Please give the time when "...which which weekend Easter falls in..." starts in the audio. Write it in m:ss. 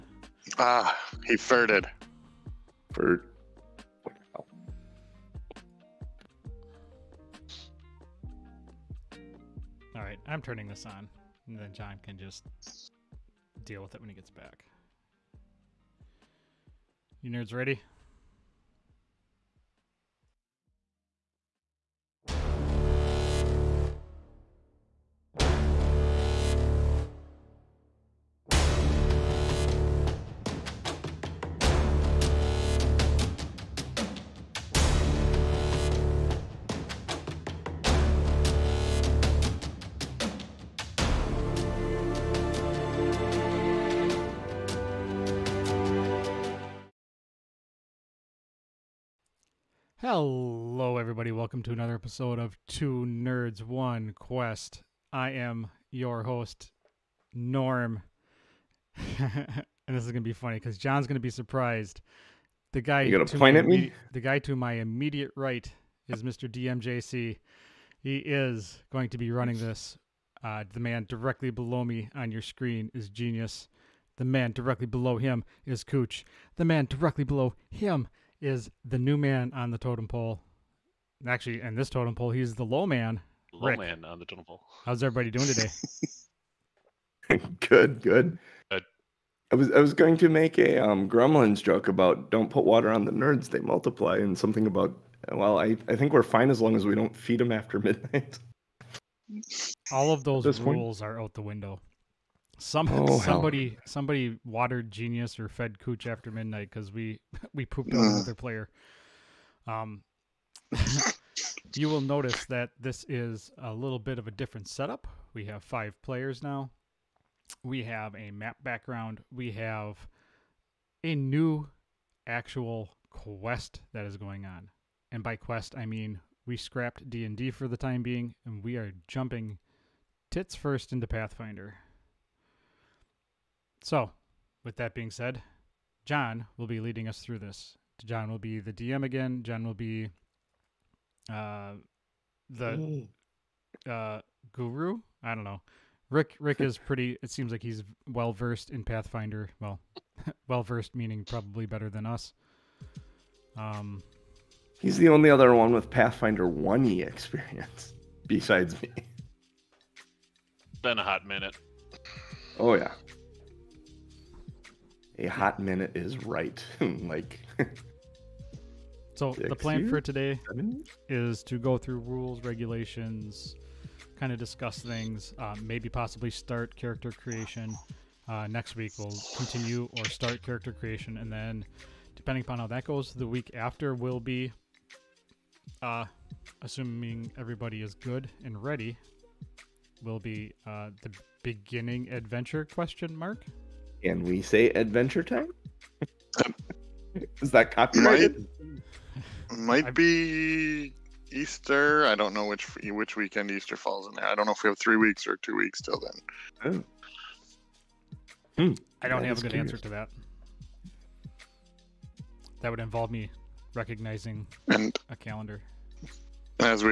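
3:22.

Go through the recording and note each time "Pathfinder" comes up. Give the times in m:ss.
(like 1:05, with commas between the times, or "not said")
2:11, 2:28, 2:35.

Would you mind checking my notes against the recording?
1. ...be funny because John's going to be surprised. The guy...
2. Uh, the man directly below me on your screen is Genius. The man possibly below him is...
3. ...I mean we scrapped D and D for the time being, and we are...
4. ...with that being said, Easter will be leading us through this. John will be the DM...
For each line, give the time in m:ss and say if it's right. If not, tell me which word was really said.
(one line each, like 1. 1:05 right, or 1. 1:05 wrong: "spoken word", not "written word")
1. 1:00 right
2. 1:10 wrong: "directly", not "possibly"
3. 2:05 right
4. 2:14 wrong: "John", not "Easter".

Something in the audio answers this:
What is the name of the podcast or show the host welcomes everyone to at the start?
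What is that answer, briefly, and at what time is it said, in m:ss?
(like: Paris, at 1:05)
Two Nerds One Quest, at 0:52.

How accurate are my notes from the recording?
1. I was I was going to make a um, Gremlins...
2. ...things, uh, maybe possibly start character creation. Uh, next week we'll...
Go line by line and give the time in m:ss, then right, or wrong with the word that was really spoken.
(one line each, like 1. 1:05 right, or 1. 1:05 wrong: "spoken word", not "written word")
1. 1:29 right
2. 2:54 right.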